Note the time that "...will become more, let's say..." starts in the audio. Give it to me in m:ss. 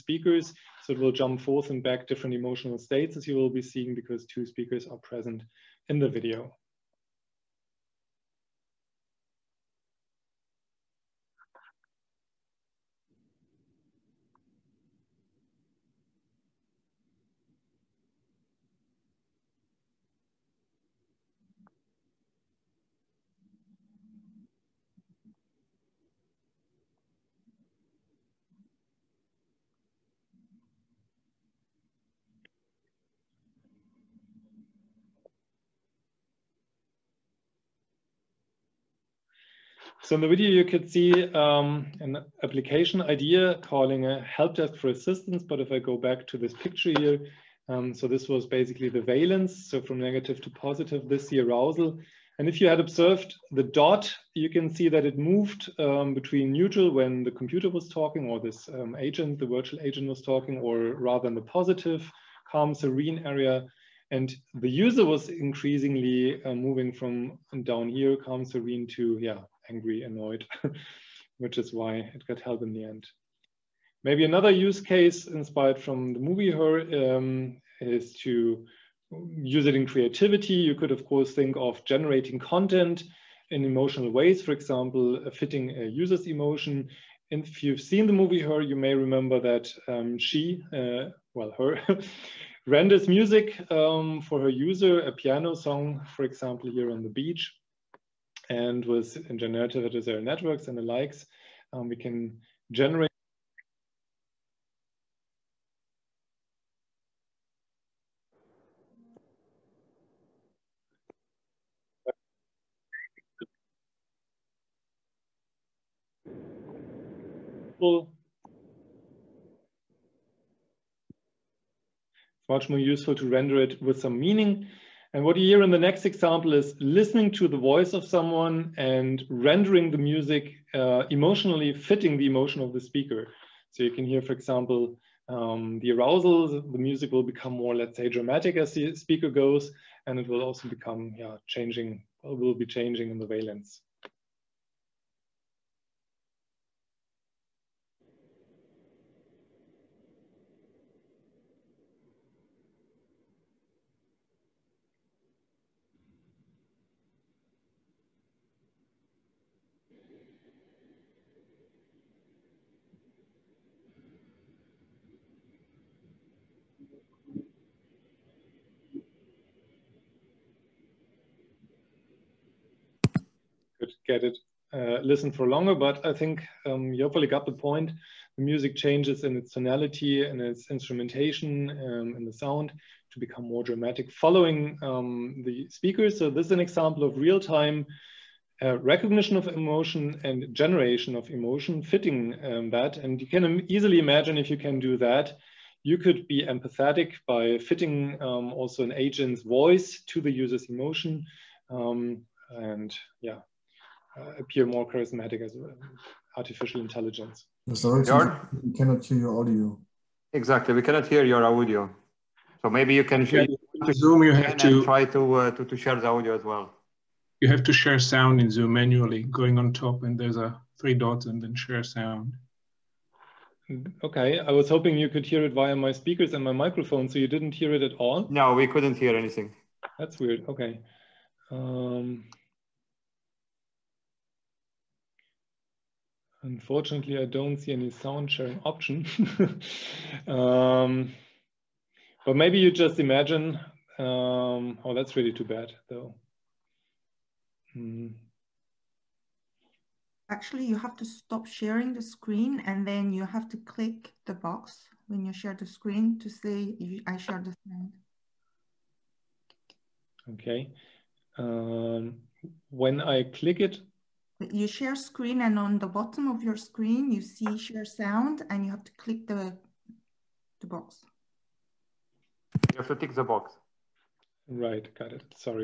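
2:17.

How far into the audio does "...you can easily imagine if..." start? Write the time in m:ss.
3:13.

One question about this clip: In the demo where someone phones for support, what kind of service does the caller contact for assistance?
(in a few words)
help desk.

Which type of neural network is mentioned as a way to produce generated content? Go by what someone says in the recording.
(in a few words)
generative adversarial networks.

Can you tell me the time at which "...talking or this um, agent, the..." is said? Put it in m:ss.
0:57.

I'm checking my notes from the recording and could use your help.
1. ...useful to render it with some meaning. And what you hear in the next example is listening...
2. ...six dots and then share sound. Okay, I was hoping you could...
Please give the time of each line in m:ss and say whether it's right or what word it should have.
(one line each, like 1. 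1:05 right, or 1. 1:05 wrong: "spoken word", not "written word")
1. 2:02 right
2. 3:40 wrong: "three", not "six".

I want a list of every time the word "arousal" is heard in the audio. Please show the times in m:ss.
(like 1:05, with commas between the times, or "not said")
0:51, 2:15.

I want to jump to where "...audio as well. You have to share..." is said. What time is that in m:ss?
3:36.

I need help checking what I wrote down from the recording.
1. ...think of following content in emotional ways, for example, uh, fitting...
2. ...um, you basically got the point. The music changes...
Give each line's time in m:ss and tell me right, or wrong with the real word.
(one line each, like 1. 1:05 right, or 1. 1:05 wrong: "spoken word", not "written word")
1. 1:21 wrong: "generating", not "following"
2. 2:56 wrong: "hopefully", not "basically".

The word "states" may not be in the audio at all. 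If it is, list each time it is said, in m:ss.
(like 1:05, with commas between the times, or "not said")
0:02.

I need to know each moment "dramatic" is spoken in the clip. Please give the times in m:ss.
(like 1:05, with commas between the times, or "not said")
2:18, 3:03.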